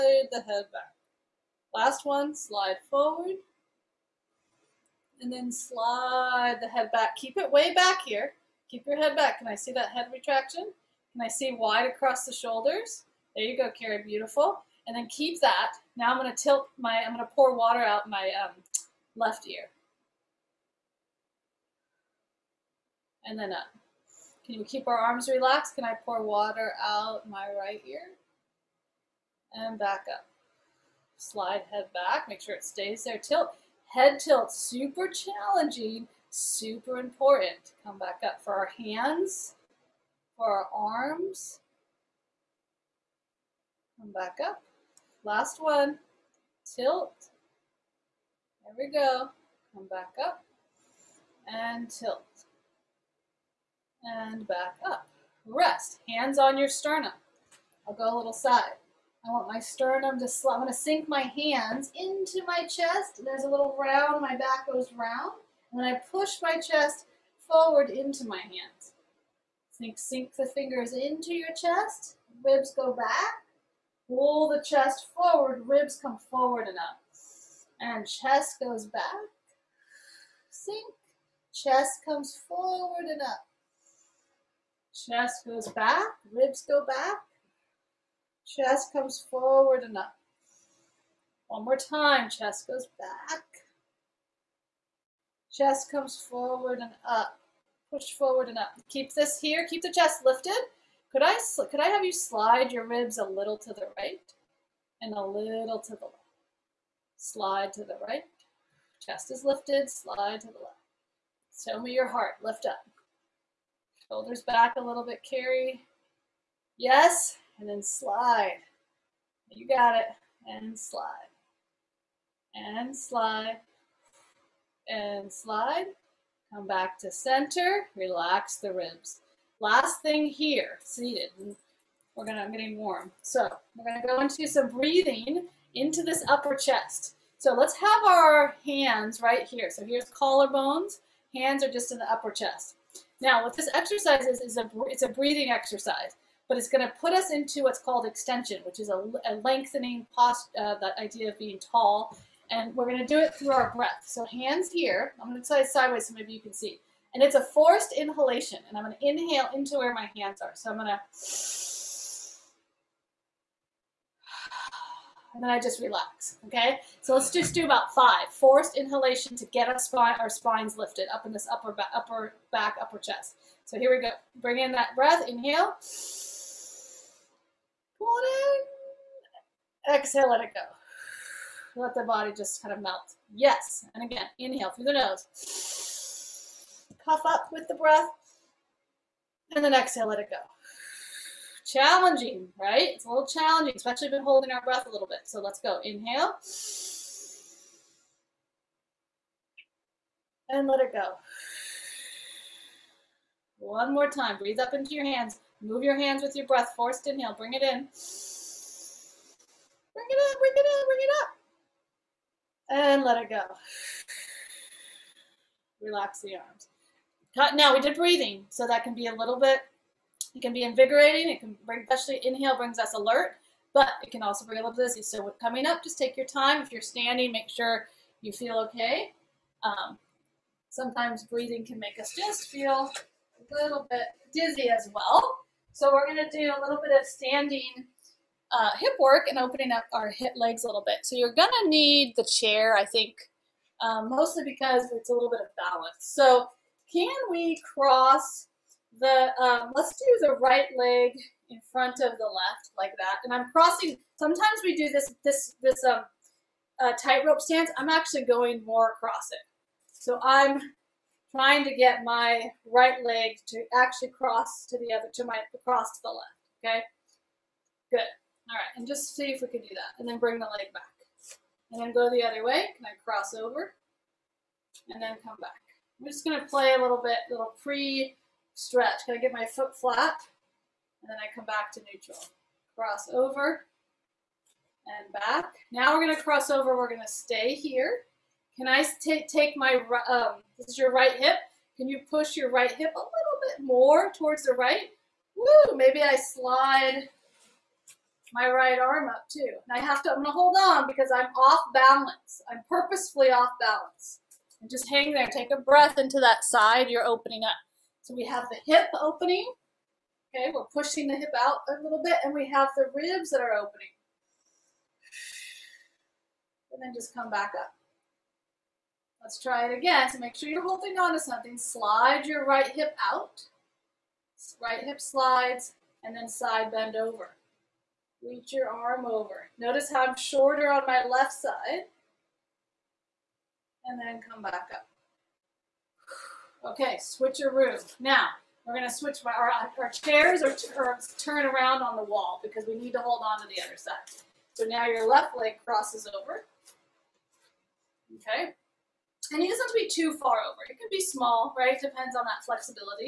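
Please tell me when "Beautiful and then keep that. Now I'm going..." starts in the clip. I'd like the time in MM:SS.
00:14.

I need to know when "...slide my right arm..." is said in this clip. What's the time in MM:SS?
04:56.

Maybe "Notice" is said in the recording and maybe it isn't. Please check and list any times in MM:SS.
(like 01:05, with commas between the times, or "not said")
05:29.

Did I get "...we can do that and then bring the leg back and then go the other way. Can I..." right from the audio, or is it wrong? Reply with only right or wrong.
right.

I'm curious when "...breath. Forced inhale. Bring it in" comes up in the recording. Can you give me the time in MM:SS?
03:26.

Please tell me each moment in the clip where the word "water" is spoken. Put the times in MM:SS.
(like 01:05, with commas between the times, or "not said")
00:17, 00:26.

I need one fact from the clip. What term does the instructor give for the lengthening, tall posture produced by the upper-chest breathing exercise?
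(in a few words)
extension.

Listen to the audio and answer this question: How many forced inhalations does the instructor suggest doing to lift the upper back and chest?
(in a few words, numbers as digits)
5.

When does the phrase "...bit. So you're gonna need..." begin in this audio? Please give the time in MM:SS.
04:00.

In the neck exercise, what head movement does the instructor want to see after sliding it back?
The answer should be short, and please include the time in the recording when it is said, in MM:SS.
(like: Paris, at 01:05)
head retraction, at 00:09.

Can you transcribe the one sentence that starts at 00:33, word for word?
Tilt, head tilt, super challenging, super important.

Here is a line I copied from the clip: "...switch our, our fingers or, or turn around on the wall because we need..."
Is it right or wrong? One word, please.
wrong.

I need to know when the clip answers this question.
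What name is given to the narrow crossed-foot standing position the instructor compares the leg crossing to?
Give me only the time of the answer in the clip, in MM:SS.
04:17.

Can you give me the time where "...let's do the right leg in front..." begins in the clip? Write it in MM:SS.
04:09.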